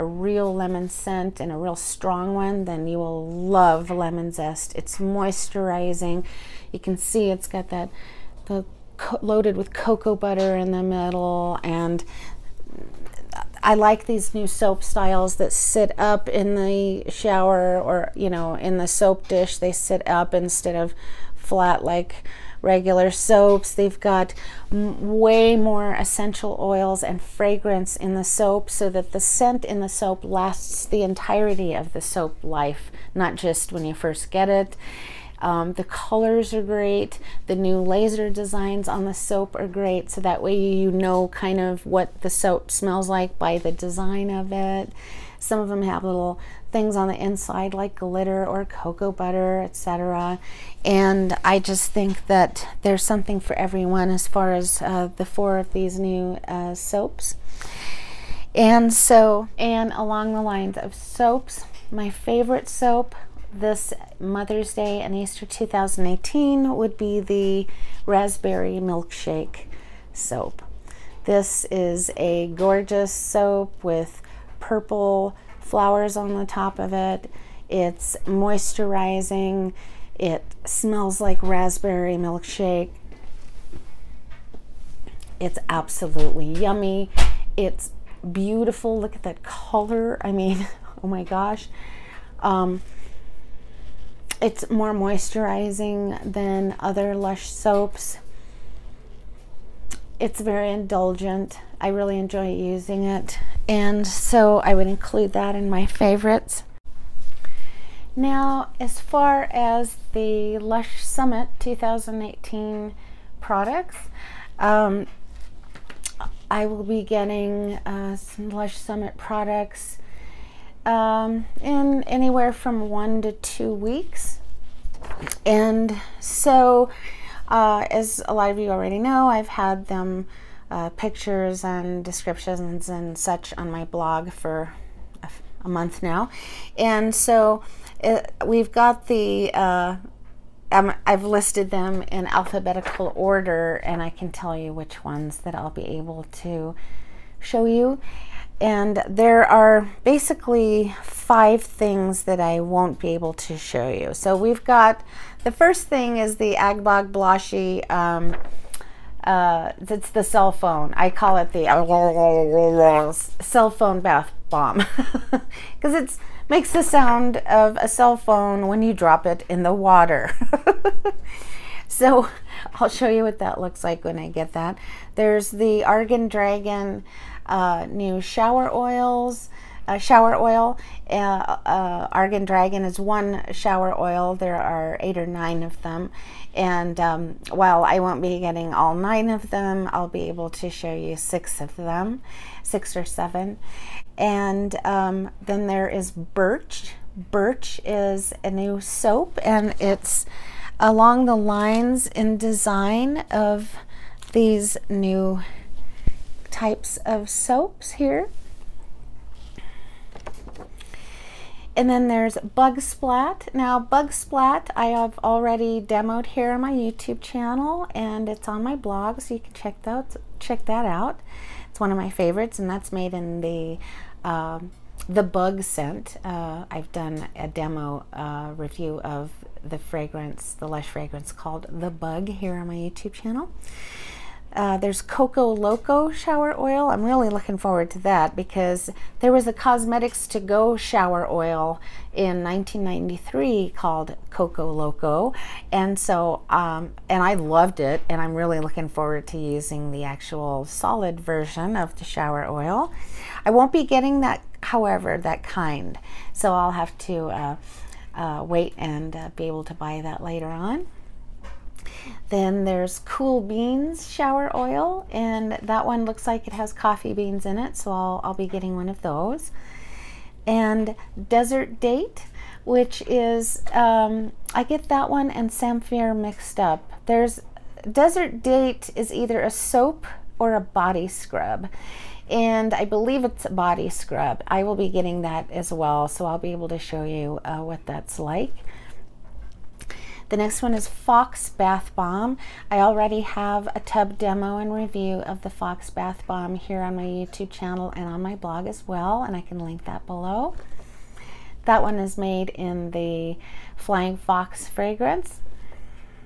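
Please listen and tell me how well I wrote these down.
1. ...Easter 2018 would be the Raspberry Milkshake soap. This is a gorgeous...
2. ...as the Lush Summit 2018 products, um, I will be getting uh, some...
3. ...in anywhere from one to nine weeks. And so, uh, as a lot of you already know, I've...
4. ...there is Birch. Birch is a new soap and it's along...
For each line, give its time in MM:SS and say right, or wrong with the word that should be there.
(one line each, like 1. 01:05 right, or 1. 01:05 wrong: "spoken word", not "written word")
1. 01:05 right
2. 01:49 right
3. 02:01 wrong: "two", not "nine"
4. 03:15 right.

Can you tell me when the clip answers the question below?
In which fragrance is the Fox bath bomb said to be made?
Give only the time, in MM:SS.
05:03.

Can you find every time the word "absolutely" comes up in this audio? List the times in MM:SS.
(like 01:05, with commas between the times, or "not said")
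01:25.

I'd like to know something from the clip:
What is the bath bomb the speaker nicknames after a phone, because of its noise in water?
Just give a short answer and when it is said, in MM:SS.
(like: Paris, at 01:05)
Agbog Bloshy, at 02:36.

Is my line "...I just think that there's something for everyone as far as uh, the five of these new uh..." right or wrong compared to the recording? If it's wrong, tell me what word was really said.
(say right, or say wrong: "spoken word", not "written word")
wrong: "four", not "five".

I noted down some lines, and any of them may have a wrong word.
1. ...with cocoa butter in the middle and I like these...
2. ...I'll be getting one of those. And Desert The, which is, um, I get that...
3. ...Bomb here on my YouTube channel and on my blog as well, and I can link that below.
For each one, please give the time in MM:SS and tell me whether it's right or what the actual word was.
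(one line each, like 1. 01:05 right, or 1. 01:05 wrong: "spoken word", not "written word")
1. 00:09 right
2. 04:28 wrong: "Date", not "The"
3. 04:56 right.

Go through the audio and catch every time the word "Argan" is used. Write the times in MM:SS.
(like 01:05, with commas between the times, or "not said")
02:55, 03:02.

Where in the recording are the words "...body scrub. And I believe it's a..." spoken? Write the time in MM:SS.
04:40.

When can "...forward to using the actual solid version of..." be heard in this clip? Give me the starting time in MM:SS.
04:08.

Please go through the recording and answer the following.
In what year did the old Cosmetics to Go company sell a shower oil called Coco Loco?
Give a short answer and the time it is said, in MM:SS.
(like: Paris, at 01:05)
1993, at 04:02.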